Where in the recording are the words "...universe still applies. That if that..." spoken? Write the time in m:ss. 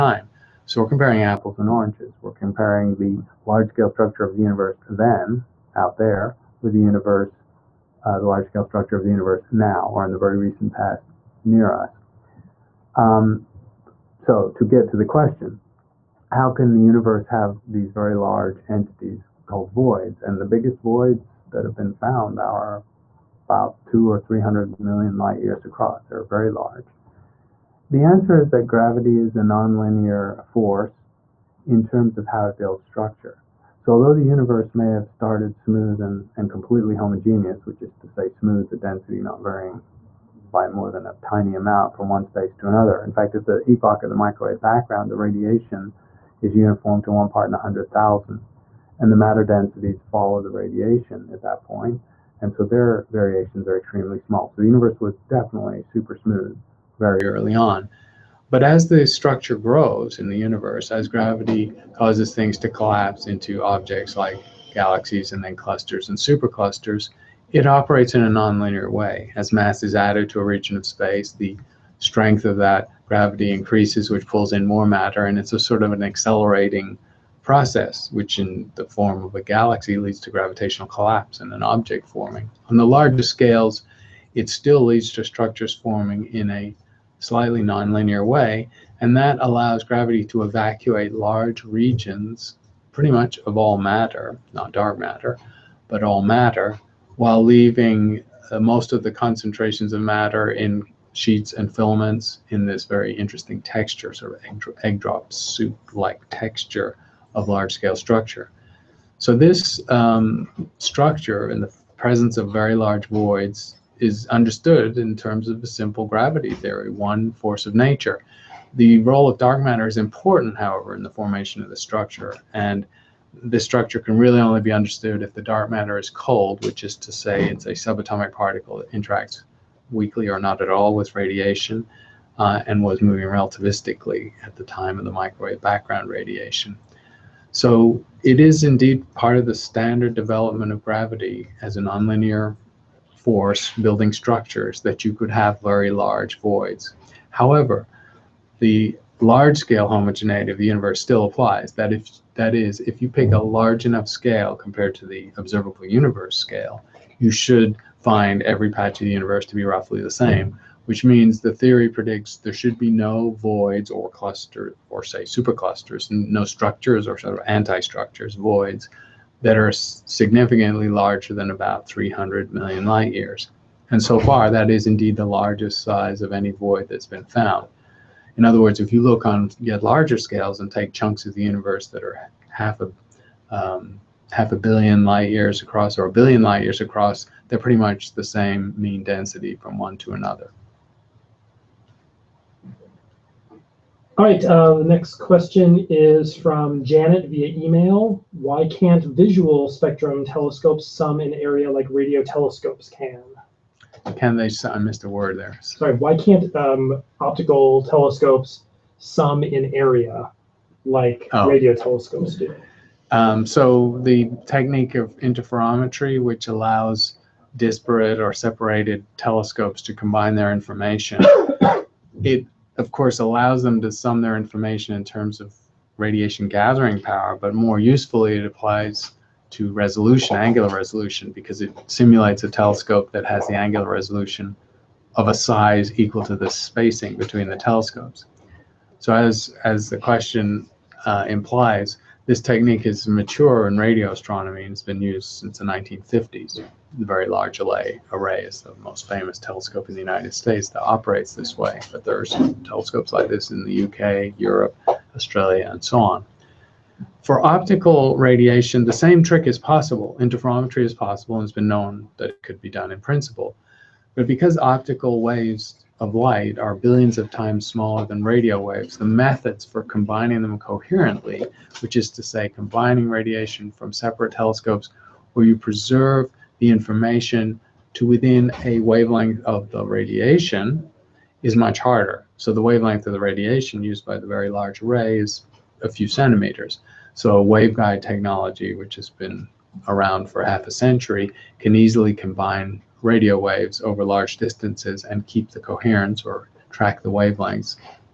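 2:30.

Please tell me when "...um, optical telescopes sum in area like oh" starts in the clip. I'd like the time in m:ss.
3:26.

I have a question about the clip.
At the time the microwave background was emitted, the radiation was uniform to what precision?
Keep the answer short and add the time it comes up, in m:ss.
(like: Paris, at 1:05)
1 part in 100,000, at 0:47.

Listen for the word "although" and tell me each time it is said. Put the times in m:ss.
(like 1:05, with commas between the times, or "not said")
0:33.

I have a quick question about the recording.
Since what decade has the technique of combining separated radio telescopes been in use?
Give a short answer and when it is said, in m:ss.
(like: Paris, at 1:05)
1950s, at 4:05.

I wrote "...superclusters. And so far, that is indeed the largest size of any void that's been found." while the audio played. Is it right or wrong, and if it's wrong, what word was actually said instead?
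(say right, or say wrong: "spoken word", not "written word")
wrong: "years", not "superclusters".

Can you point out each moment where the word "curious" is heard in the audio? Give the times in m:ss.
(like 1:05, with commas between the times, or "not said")
not said.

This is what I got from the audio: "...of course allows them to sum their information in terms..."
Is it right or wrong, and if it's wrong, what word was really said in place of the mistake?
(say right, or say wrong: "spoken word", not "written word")
right.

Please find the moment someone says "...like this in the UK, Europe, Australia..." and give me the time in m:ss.
4:13.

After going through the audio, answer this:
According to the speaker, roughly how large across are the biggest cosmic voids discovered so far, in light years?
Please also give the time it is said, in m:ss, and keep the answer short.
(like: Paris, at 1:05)
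200 to 300 million light years, at 0:23.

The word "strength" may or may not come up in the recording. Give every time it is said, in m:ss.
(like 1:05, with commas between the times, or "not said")
1:11.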